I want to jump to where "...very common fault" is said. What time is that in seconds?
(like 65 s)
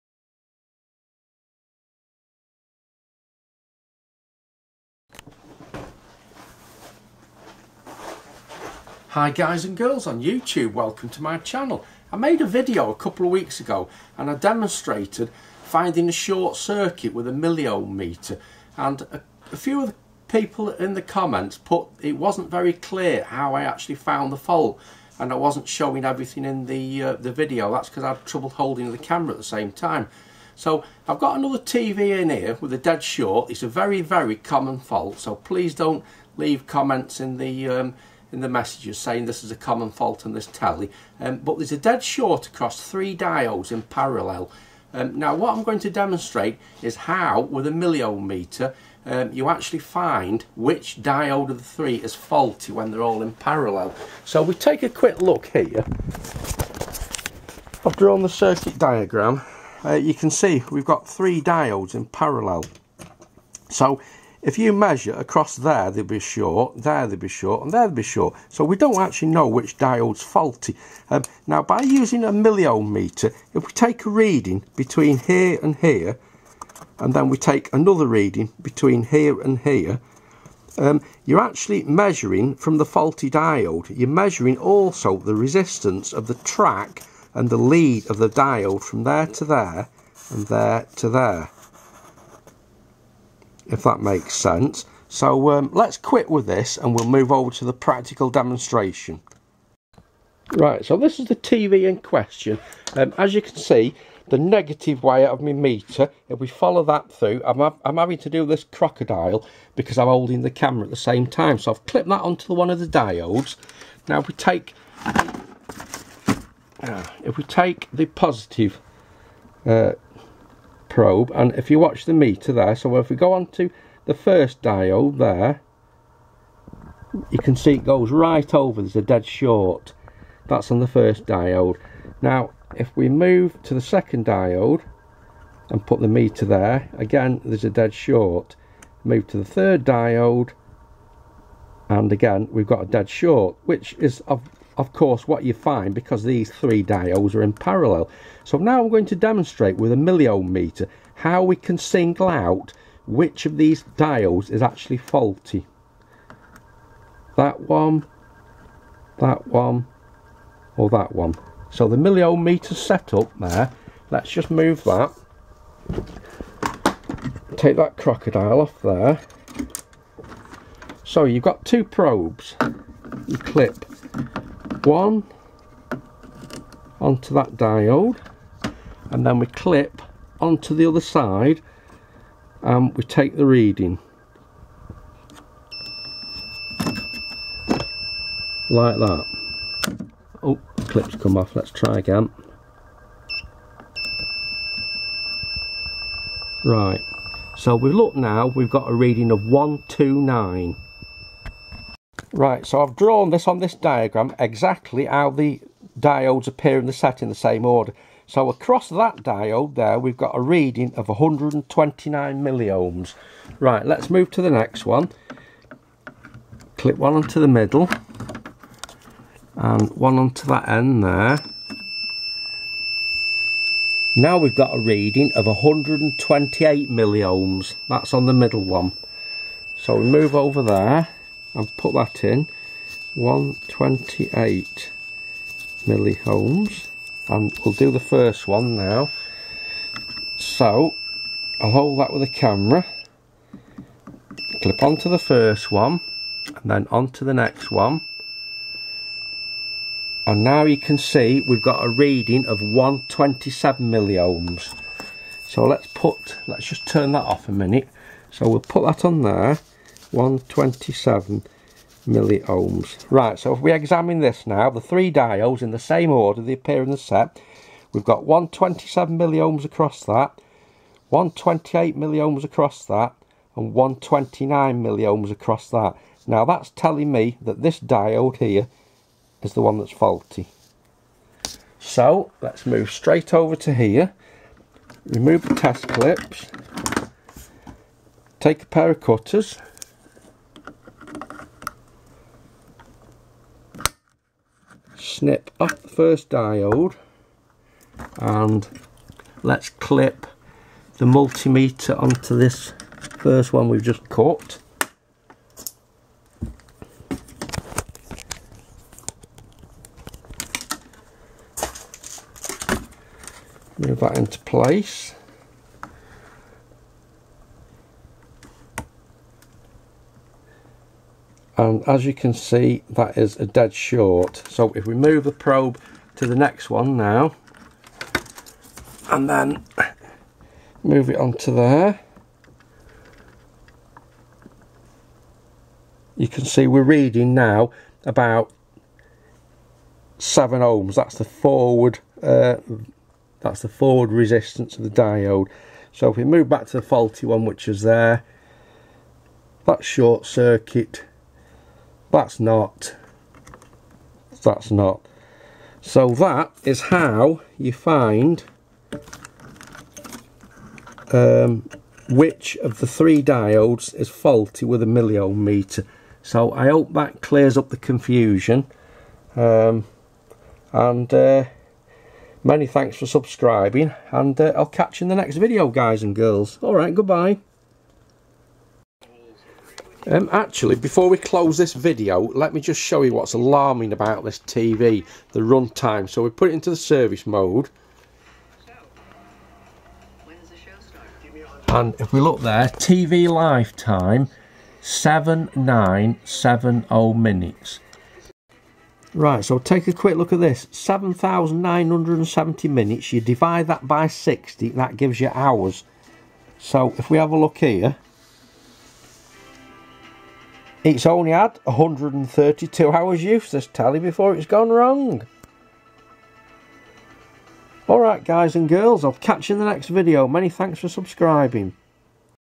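33 s.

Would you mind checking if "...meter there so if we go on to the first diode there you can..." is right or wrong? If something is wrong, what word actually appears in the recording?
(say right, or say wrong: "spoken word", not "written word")
right.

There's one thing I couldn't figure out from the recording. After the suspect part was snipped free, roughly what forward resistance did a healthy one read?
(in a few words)
about 7 ohms.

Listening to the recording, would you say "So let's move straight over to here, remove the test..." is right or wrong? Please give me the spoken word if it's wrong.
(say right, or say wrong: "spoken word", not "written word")
right.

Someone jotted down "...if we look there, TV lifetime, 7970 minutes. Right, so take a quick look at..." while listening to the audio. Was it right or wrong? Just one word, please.
right.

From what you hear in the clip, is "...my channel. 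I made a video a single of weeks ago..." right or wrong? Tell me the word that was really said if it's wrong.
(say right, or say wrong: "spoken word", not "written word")
wrong: "couple", not "single".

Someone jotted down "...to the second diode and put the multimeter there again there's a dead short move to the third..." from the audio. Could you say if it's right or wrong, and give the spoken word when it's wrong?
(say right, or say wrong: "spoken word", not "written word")
wrong: "meter", not "multimeter".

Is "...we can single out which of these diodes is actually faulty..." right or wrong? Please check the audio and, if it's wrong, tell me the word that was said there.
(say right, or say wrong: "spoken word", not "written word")
right.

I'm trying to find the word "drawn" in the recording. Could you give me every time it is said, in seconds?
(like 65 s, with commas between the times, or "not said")
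57 s, 202 s.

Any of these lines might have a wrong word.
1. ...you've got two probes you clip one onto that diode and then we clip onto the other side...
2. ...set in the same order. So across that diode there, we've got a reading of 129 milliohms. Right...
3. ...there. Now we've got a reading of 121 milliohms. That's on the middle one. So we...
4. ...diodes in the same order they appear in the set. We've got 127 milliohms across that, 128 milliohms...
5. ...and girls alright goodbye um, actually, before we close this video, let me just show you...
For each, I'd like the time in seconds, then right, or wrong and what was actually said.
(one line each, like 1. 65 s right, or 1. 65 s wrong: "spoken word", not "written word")
1. 171 s right
2. 206 s right
3. 221 s wrong: "128", not "121"
4. 265 s right
5. 376 s right.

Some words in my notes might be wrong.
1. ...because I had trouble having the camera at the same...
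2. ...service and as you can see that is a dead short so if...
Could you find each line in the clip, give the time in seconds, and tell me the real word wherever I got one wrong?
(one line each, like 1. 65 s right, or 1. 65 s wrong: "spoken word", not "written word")
1. 27 s wrong: "holding", not "having"
2. 314 s wrong: "place", not "service".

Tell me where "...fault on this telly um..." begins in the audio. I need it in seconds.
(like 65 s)
39 s.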